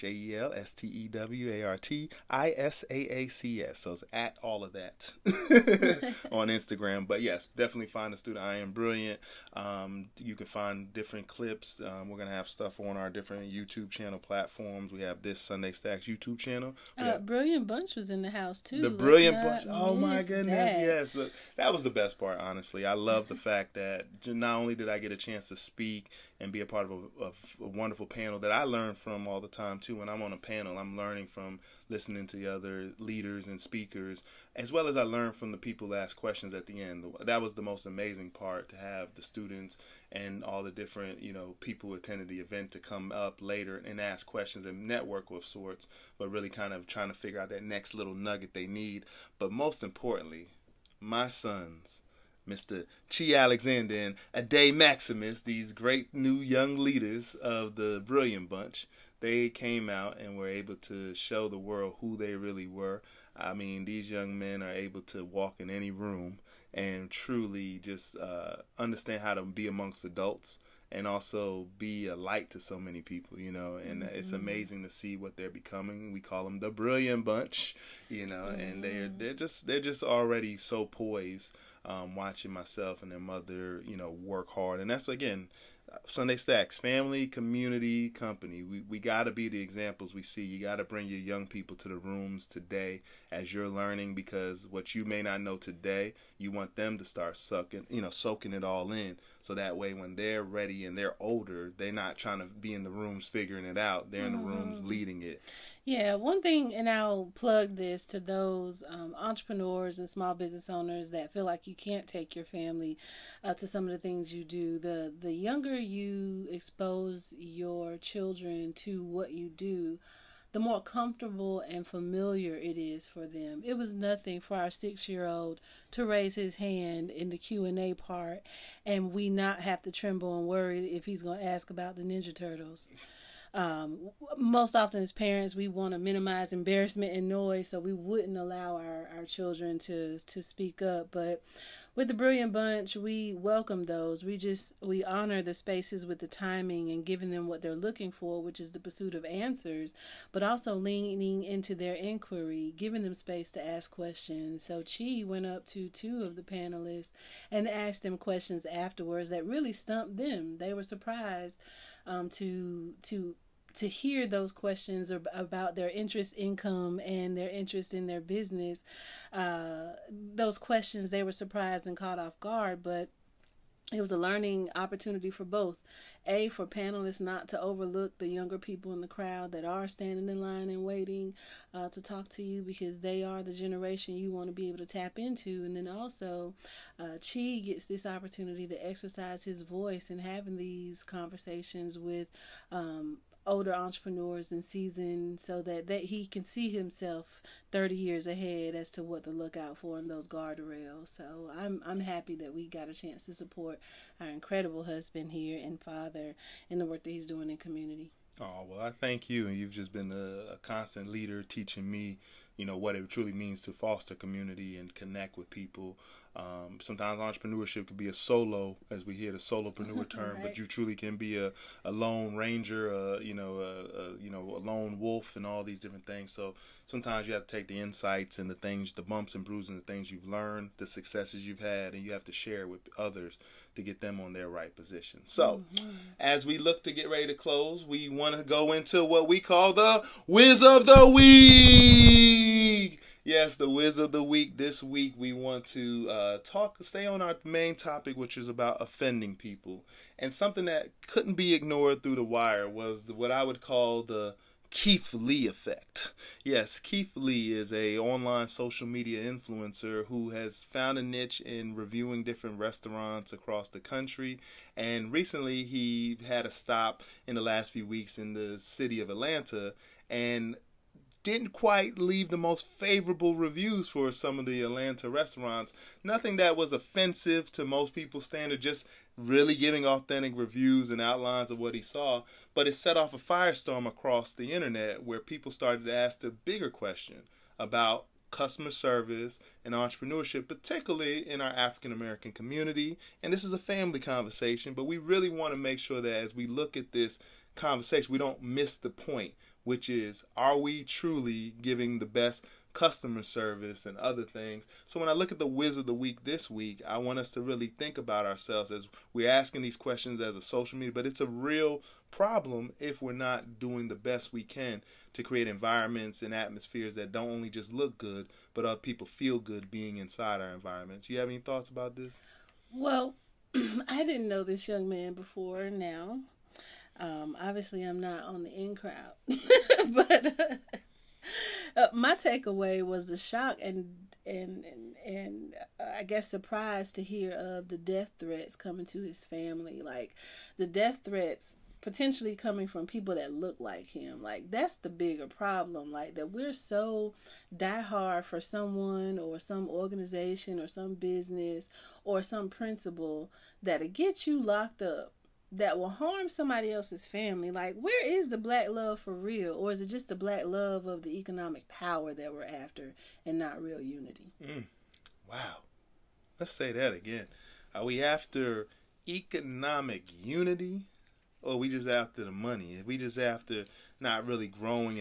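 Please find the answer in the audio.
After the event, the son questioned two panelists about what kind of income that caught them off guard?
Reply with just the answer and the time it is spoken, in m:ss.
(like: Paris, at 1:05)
interest income, at 2:45.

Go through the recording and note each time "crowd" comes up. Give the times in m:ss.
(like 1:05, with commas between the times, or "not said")
2:59, 5:28.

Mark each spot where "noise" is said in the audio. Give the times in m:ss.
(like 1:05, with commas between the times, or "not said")
2:17.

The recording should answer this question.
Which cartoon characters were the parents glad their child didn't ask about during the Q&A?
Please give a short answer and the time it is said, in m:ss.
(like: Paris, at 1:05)
Ninja Turtles, at 2:12.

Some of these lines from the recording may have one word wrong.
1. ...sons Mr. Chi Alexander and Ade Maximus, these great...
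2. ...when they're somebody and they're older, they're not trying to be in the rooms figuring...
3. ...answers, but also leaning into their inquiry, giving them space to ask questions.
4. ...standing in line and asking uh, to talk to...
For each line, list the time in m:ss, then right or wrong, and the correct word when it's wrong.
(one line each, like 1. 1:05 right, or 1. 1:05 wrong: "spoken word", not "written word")
1. 0:51 right
2. 1:39 wrong: "ready", not "somebody"
3. 2:29 right
4. 2:59 wrong: "waiting", not "asking".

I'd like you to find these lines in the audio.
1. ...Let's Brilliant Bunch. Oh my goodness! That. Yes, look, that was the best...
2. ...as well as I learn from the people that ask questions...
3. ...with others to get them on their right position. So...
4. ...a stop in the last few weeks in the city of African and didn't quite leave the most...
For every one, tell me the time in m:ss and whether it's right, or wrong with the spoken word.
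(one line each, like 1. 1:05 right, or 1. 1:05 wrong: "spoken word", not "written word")
1. 0:18 right
2. 0:34 right
3. 3:52 right
4. 4:26 wrong: "Atlanta", not "African".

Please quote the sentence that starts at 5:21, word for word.
You have any thoughts about this?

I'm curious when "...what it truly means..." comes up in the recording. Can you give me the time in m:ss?
3:32.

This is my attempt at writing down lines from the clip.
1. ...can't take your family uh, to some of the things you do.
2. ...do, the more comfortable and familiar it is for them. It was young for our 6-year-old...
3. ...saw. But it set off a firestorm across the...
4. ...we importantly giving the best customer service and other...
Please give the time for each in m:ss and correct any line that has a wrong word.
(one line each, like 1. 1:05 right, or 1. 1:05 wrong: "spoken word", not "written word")
1. 1:51 right
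2. 1:59 wrong: "nothing", not "young"
3. 4:41 right
4. 5:00 wrong: "truly", not "importantly".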